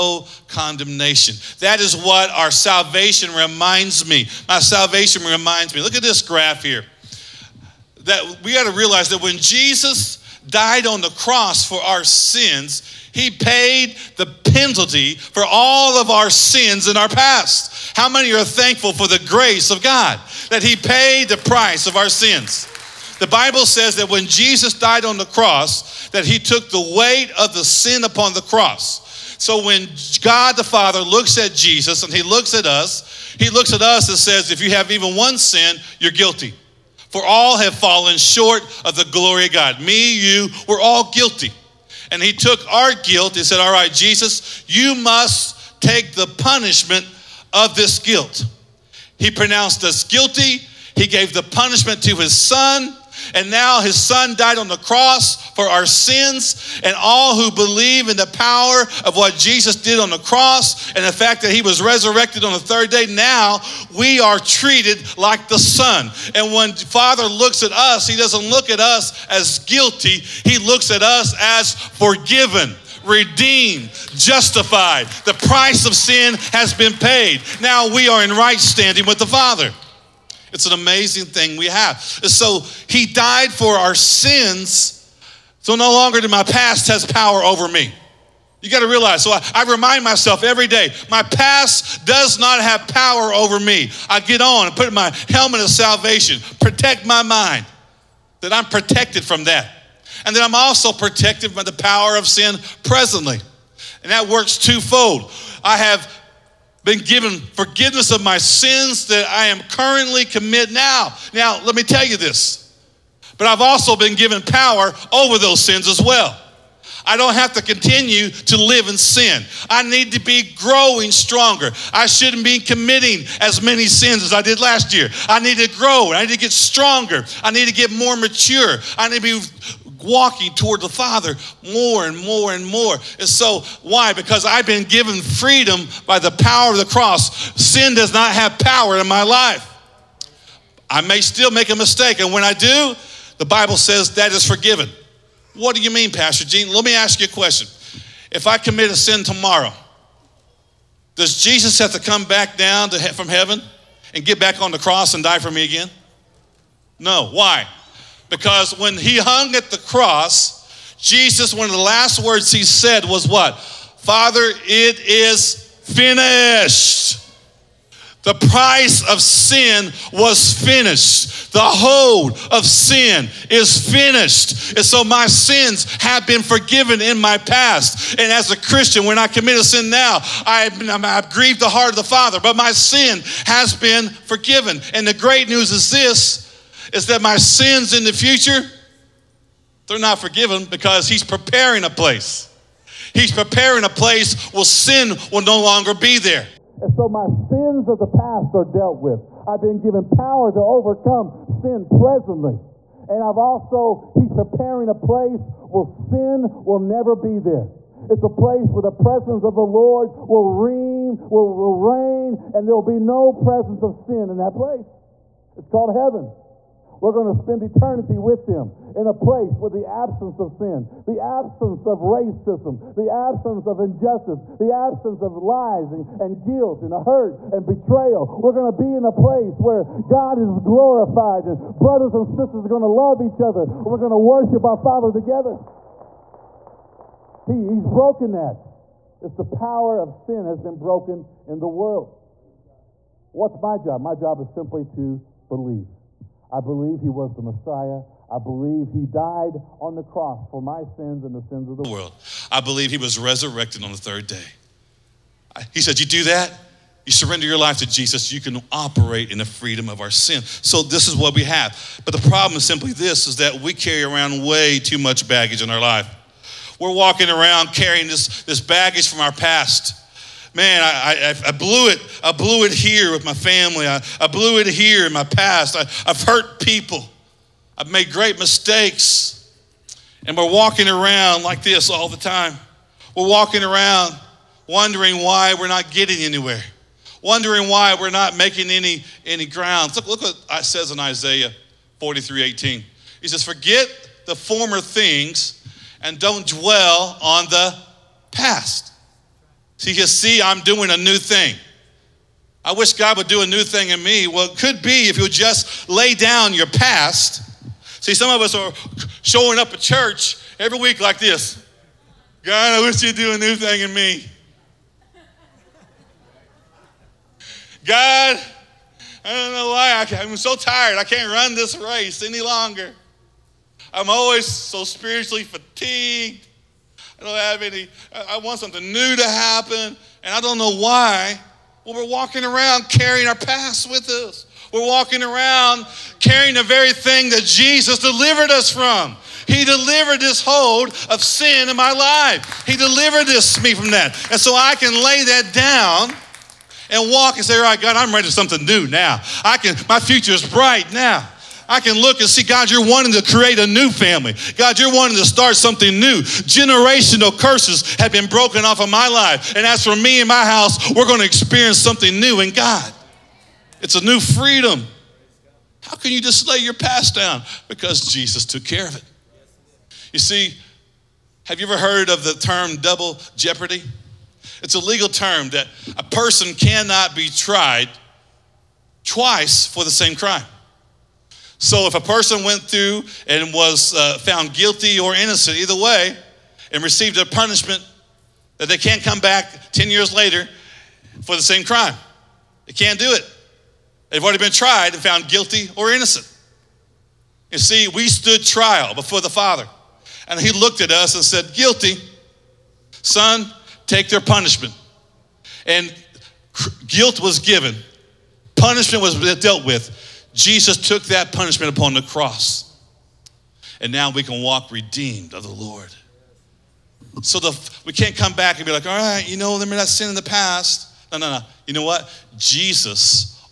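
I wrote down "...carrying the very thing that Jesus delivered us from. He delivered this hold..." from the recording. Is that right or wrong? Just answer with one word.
right.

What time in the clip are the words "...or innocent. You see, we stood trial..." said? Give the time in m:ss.
6:35.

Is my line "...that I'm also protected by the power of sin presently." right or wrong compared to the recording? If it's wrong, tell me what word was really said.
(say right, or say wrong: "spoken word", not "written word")
right.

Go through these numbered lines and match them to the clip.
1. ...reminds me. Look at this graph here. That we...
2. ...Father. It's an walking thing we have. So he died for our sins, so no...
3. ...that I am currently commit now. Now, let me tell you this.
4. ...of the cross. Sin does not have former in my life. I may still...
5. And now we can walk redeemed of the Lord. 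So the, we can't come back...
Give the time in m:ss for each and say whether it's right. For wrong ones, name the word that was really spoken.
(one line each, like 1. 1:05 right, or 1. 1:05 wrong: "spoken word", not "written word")
1. 0:05 right
2. 1:19 wrong: "amazing", not "walking"
3. 1:49 right
4. 2:16 wrong: "power", not "former"
5. 6:53 right.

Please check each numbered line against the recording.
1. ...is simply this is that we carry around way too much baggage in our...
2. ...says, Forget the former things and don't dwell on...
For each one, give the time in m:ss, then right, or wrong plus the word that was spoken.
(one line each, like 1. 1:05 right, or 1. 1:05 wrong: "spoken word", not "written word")
1. 4:22 right
2. 4:53 right.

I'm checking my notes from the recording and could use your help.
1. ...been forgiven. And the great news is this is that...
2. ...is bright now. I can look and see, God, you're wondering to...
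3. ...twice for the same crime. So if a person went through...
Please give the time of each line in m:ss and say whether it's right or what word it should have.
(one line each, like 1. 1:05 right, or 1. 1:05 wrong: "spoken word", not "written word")
1. 3:03 right
2. 5:50 wrong: "wanting", not "wondering"
3. 6:19 right.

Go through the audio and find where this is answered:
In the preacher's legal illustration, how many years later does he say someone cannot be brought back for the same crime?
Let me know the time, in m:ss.
6:29.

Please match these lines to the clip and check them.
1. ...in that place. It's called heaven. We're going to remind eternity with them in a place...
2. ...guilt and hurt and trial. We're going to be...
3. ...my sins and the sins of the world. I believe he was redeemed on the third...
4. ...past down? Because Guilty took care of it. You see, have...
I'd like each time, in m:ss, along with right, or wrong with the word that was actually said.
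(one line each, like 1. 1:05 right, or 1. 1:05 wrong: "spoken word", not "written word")
1. 3:34 wrong: "spend", not "remind"
2. 3:46 wrong: "betrayal", not "trial"
3. 4:10 wrong: "resurrected", not "redeemed"
4. 6:06 wrong: "Jesus", not "Guilty".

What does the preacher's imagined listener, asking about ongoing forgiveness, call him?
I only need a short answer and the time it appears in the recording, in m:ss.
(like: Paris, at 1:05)
Pastor Gene, at 2:26.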